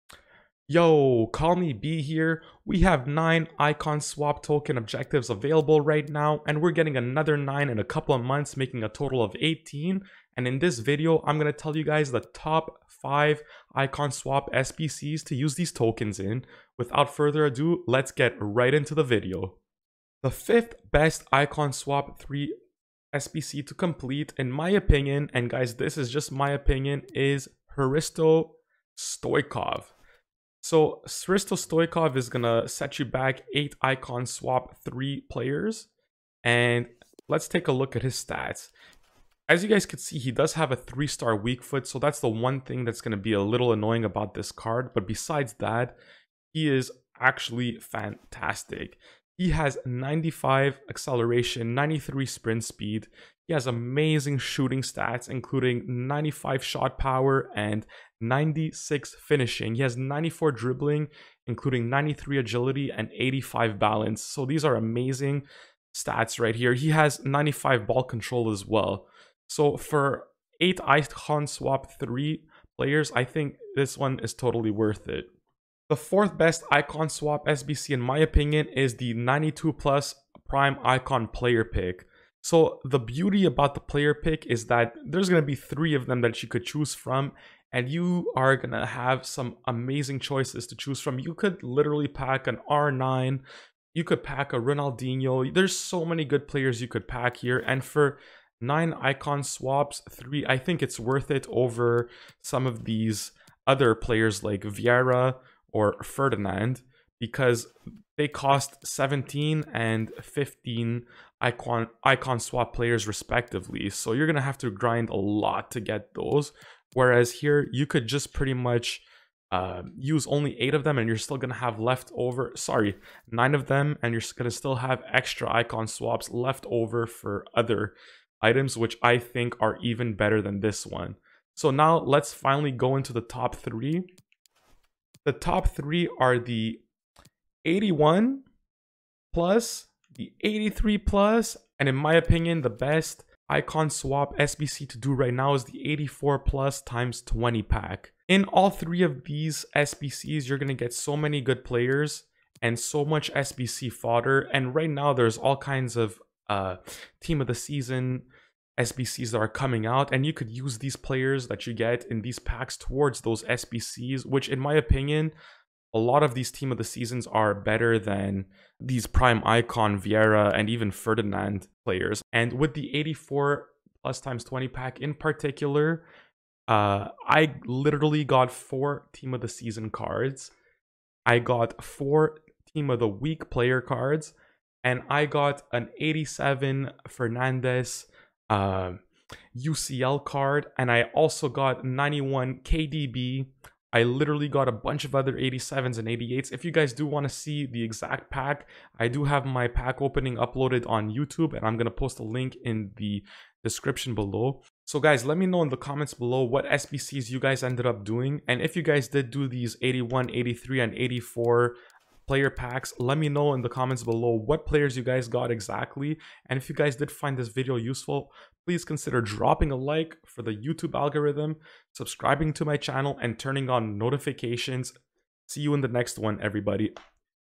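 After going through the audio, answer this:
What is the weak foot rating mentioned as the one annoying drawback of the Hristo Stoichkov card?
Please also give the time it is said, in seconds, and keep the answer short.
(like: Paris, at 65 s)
3-star, at 40 s.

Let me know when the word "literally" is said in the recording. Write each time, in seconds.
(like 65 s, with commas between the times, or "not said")
91 s, 177 s, 194 s.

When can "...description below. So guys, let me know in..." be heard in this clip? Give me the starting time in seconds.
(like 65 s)
203 s.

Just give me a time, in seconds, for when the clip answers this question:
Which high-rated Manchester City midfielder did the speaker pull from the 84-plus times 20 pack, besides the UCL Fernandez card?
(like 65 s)
191 s.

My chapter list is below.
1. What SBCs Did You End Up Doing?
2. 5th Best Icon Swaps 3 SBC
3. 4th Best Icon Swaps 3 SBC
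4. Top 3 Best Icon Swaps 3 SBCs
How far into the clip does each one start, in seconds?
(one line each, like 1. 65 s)
1. 204 s
2. 20 s
3. 75 s
4. 134 s.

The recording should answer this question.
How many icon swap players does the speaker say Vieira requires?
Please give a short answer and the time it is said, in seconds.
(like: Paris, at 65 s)
17, at 108 s.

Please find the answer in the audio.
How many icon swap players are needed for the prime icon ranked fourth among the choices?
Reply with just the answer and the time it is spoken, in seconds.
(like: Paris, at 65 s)
9, at 98 s.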